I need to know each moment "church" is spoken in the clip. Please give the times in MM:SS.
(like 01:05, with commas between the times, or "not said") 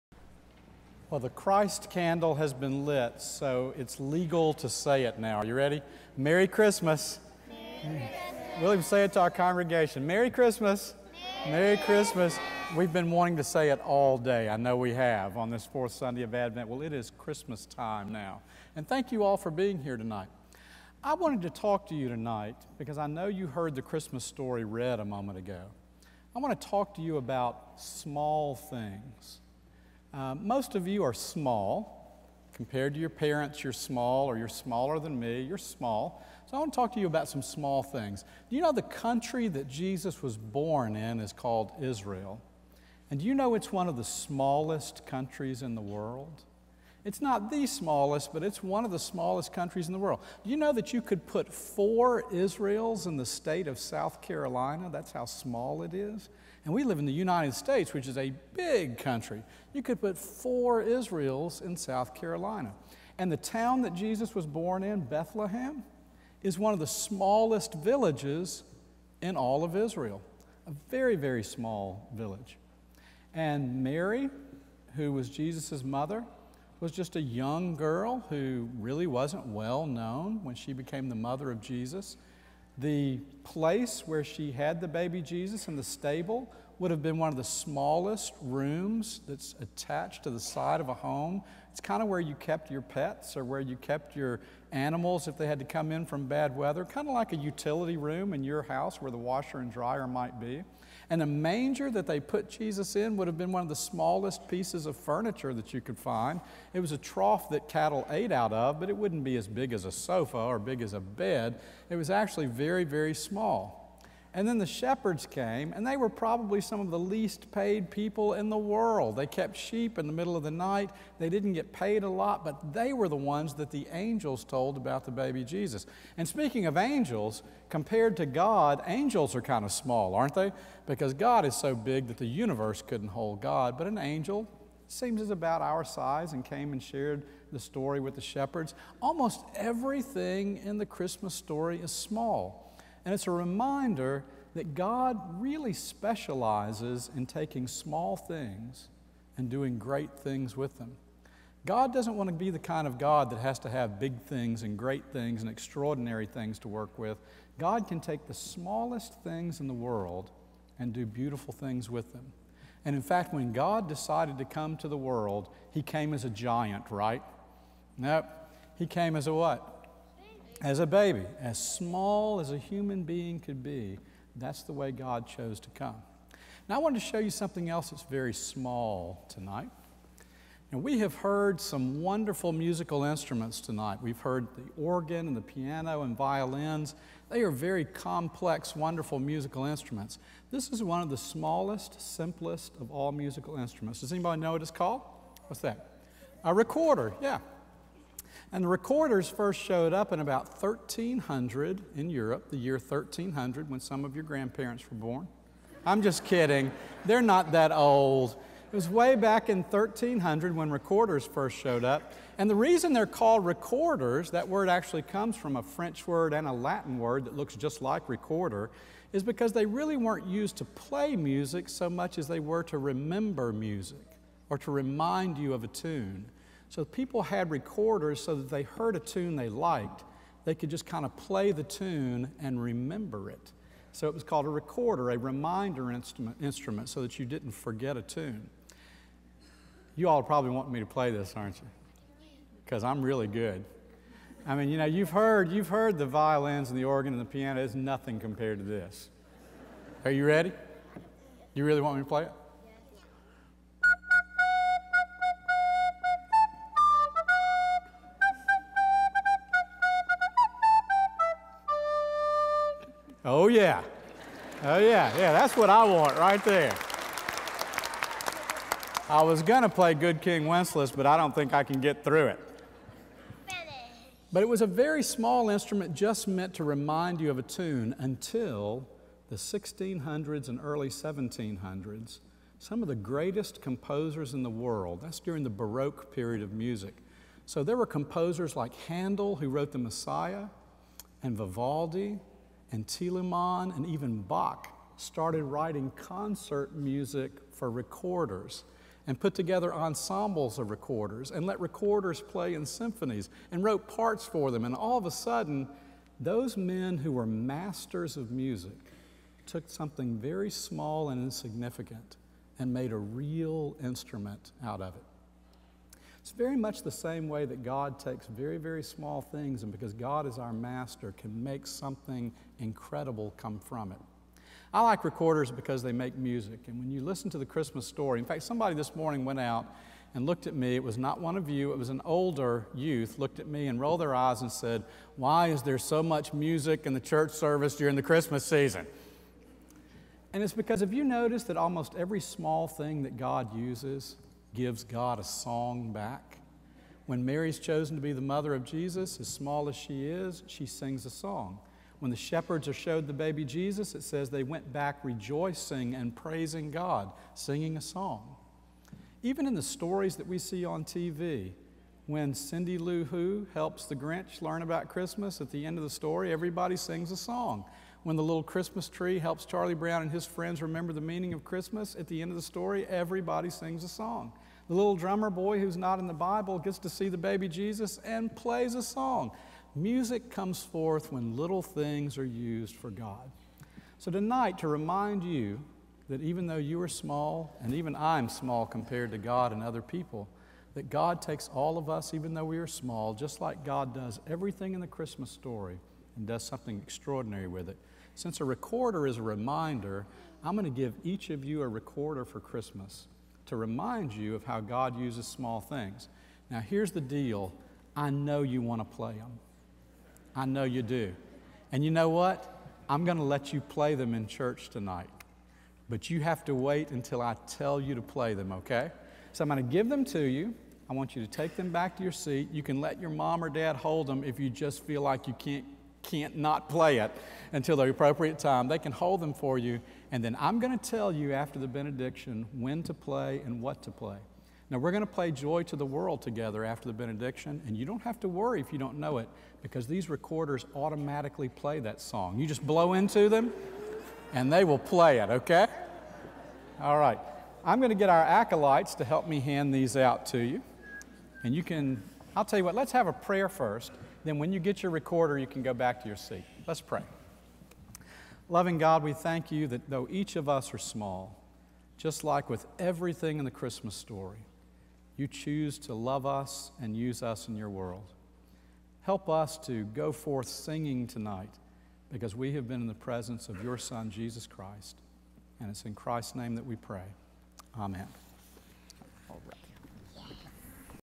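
05:36, 06:54.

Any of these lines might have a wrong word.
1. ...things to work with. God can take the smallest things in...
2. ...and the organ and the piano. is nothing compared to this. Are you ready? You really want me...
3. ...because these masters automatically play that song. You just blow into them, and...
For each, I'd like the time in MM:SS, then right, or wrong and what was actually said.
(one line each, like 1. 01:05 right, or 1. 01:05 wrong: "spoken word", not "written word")
1. 02:36 right
2. 04:06 right
3. 07:19 wrong: "recorders", not "masters".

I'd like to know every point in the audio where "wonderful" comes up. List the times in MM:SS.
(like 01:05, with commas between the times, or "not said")
03:02, 03:08.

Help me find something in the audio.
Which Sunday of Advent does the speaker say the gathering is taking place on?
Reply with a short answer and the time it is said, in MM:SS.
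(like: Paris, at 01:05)
Fourth, at 00:15.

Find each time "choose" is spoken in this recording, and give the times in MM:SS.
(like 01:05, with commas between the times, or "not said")
07:45.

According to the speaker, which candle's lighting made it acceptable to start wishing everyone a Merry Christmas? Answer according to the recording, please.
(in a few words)
Christ candle.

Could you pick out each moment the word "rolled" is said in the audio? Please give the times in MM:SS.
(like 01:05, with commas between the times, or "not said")
05:33.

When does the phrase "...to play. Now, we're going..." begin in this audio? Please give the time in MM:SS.
07:13.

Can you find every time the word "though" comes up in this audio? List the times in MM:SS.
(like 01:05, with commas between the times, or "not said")
06:26, 06:32, 07:39.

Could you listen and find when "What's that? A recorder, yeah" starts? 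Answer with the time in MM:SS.
03:15.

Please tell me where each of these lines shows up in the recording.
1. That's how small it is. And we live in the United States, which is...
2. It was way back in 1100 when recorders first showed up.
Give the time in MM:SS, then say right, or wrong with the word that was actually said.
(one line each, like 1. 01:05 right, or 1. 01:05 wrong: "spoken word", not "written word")
1. 00:54 right
2. 03:28 wrong: "1300", not "1100".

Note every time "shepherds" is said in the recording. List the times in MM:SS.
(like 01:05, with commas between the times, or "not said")
01:54, 02:18, 05:52.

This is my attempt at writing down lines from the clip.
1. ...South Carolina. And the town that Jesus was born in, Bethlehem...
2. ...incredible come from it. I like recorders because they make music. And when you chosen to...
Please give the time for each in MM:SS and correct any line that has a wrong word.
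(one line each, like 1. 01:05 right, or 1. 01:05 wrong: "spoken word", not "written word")
1. 01:01 right
2. 05:22 wrong: "listen", not "chosen".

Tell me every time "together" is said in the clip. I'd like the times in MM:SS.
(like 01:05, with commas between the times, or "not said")
04:59, 07:16.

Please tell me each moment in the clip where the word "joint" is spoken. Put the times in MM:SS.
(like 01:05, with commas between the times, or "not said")
not said.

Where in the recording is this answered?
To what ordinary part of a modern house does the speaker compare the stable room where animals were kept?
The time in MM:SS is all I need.
01:37.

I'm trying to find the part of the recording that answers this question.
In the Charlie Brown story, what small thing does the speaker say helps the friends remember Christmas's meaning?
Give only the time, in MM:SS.
06:08.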